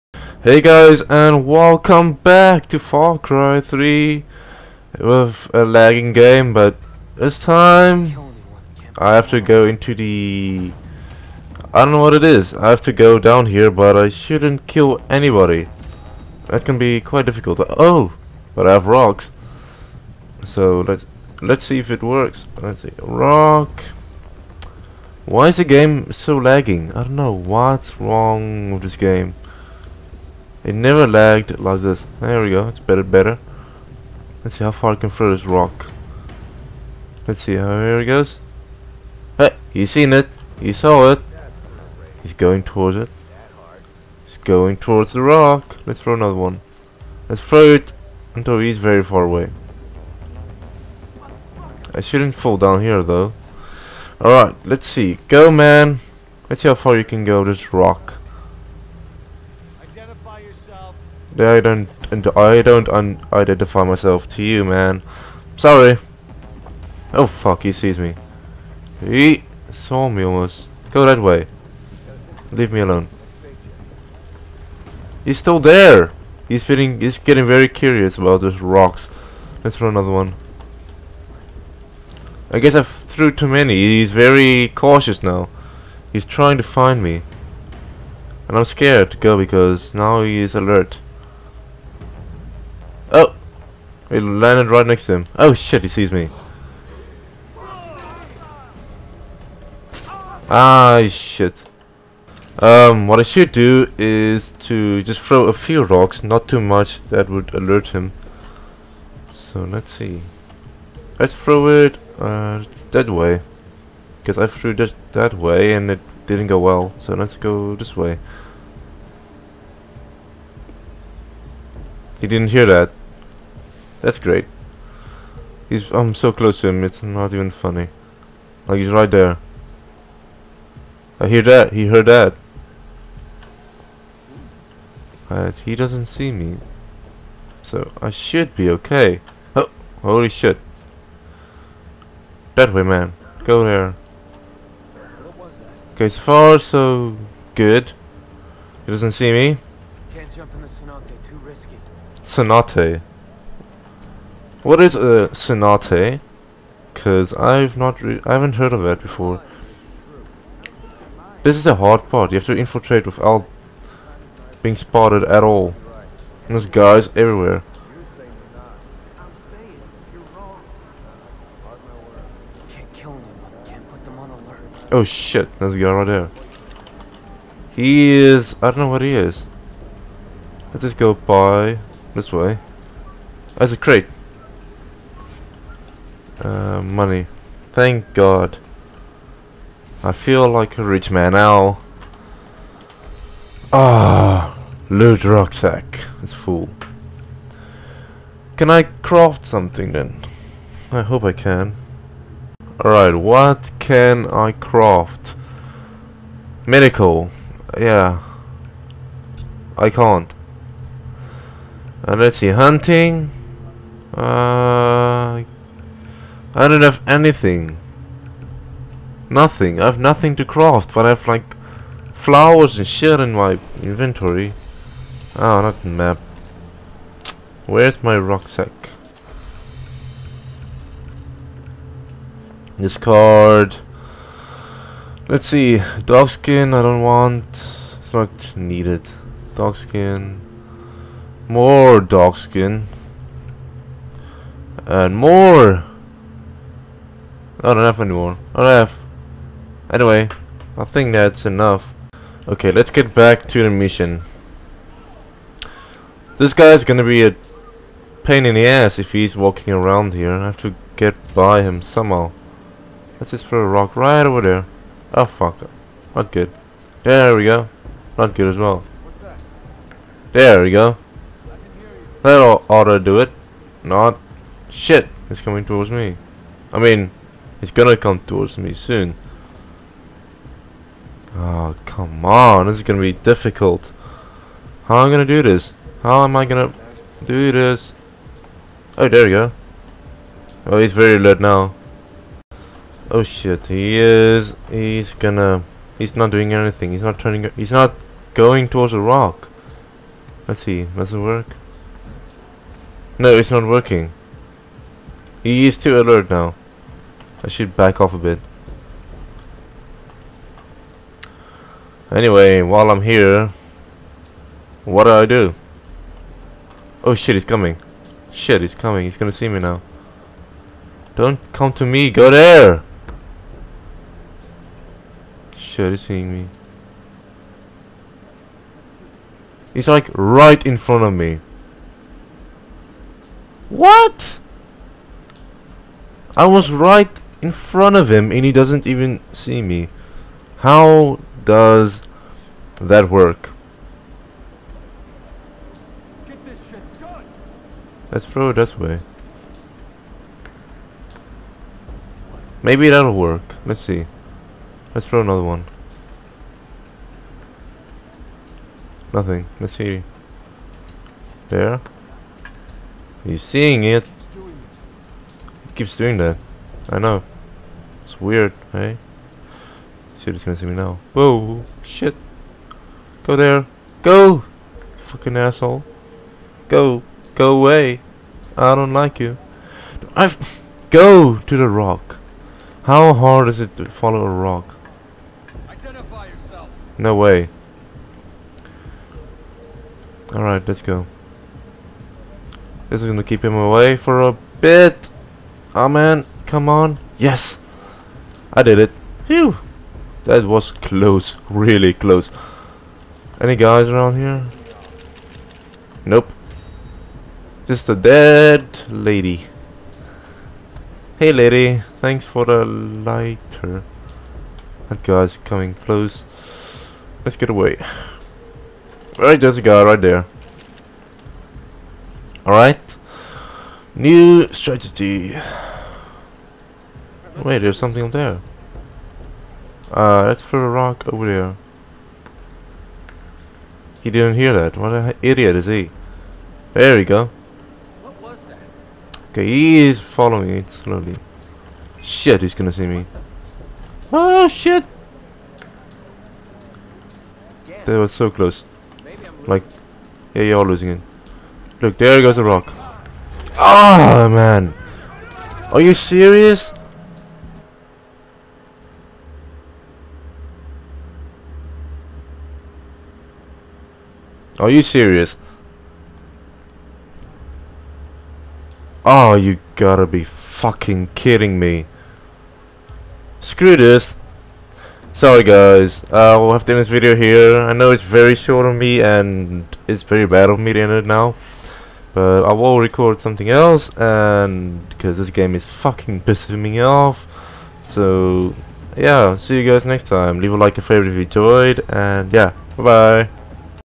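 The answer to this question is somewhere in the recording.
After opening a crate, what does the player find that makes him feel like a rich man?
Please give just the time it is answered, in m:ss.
3:06.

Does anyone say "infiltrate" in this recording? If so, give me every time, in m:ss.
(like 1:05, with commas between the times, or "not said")
2:42.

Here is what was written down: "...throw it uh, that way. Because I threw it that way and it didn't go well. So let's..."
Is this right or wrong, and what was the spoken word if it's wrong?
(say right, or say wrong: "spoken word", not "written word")
right.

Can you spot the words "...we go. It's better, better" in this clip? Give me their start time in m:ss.
0:32.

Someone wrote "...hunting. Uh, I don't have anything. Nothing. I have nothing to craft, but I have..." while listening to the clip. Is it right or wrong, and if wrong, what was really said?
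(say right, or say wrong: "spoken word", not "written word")
right.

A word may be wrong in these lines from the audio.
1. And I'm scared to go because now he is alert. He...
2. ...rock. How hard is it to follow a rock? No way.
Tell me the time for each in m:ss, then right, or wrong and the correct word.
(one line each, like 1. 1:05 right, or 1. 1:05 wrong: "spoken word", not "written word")
1. 1:28 right
2. 6:21 right.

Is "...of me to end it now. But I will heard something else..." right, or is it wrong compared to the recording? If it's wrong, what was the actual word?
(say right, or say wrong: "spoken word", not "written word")
wrong: "record", not "heard".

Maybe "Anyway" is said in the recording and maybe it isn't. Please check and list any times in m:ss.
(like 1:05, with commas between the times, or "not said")
4:09, 5:12.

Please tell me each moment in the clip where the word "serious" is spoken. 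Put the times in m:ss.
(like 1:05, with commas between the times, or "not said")
7:35, 7:44.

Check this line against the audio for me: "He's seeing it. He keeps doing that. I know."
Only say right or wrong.
right.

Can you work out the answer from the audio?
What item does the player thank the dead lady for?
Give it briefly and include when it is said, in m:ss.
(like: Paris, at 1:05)
The lighter, at 6:52.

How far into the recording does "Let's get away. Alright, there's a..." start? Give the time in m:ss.
6:57.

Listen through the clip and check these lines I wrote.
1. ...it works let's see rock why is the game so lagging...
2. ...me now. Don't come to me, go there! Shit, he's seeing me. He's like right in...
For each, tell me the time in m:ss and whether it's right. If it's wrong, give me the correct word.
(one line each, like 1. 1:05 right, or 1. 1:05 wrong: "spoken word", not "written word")
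1. 0:21 right
2. 5:19 right.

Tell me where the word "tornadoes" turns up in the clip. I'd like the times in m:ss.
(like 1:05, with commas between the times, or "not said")
not said.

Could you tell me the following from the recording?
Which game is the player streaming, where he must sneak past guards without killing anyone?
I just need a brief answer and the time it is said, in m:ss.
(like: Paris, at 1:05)
Far Cry 3, at 0:02.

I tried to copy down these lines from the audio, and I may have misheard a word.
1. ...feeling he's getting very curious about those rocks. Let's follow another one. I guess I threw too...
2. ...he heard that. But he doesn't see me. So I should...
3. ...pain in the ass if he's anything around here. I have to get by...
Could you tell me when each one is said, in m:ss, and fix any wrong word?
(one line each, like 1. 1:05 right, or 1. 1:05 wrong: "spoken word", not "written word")
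1. 1:16 wrong: "throw", not "follow"
2. 2:11 right
3. 4:18 wrong: "walking", not "anything".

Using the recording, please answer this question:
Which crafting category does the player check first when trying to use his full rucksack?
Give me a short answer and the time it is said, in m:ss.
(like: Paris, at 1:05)
Medical, at 3:26.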